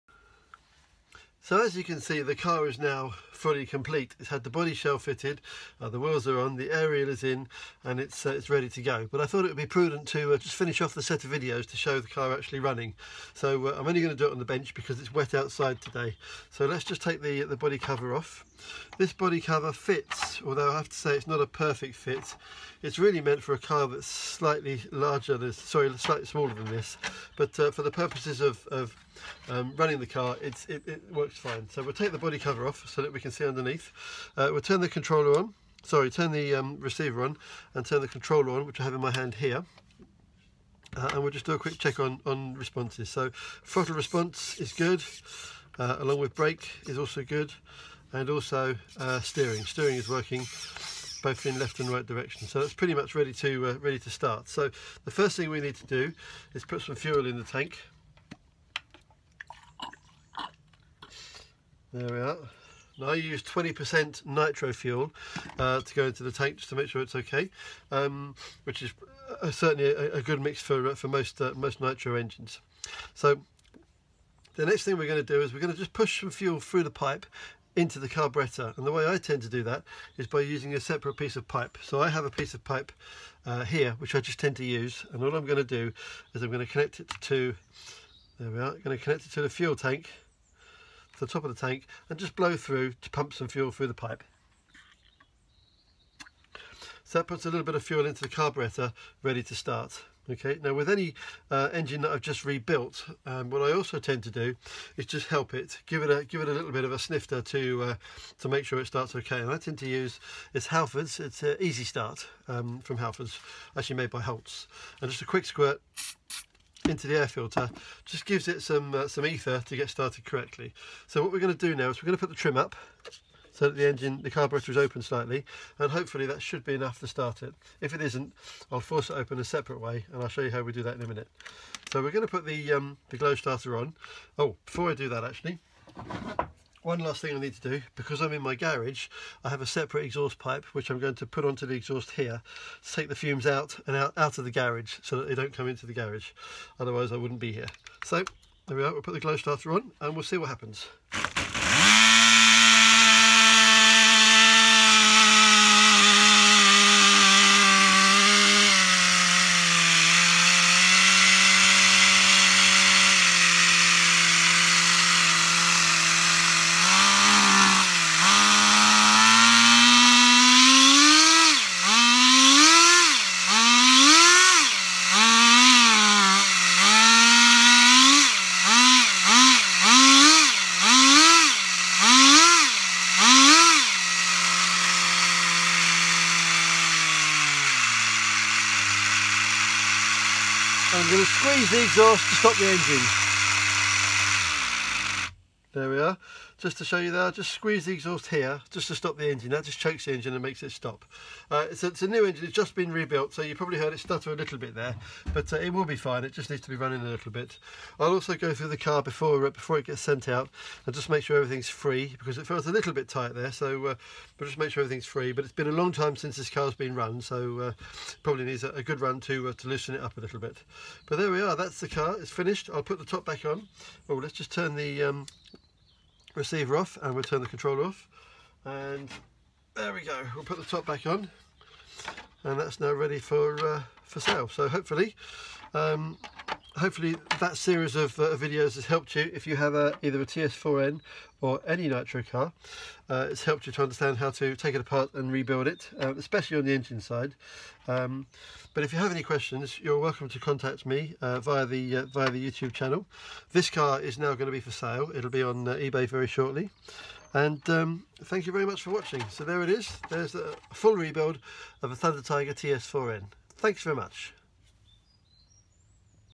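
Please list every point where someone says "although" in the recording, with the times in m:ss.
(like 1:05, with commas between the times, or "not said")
0:20.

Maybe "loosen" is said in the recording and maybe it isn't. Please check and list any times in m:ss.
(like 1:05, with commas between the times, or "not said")
3:39.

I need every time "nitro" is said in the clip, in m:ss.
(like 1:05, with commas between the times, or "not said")
1:04, 1:11, 4:01.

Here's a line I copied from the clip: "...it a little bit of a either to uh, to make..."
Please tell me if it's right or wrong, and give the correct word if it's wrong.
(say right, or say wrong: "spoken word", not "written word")
wrong: "snifter", not "either".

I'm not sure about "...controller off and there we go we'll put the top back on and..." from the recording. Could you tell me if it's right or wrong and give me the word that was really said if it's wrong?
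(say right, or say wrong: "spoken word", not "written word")
right.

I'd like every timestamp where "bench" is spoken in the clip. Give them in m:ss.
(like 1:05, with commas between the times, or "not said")
0:14.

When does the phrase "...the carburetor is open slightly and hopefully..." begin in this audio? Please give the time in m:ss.
2:04.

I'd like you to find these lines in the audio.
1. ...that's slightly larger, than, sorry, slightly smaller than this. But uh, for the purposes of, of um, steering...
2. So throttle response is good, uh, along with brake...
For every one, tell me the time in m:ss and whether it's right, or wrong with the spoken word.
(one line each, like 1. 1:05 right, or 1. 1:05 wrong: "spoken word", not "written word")
1. 0:23 wrong: "running", not "steering"
2. 0:43 right.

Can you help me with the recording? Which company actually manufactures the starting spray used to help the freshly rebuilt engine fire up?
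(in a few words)
Holts.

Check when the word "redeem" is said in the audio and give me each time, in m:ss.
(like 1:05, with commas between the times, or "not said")
not said.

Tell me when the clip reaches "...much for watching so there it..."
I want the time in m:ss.
4:18.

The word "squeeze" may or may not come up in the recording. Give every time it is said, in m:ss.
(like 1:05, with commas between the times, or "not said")
3:11, 3:17.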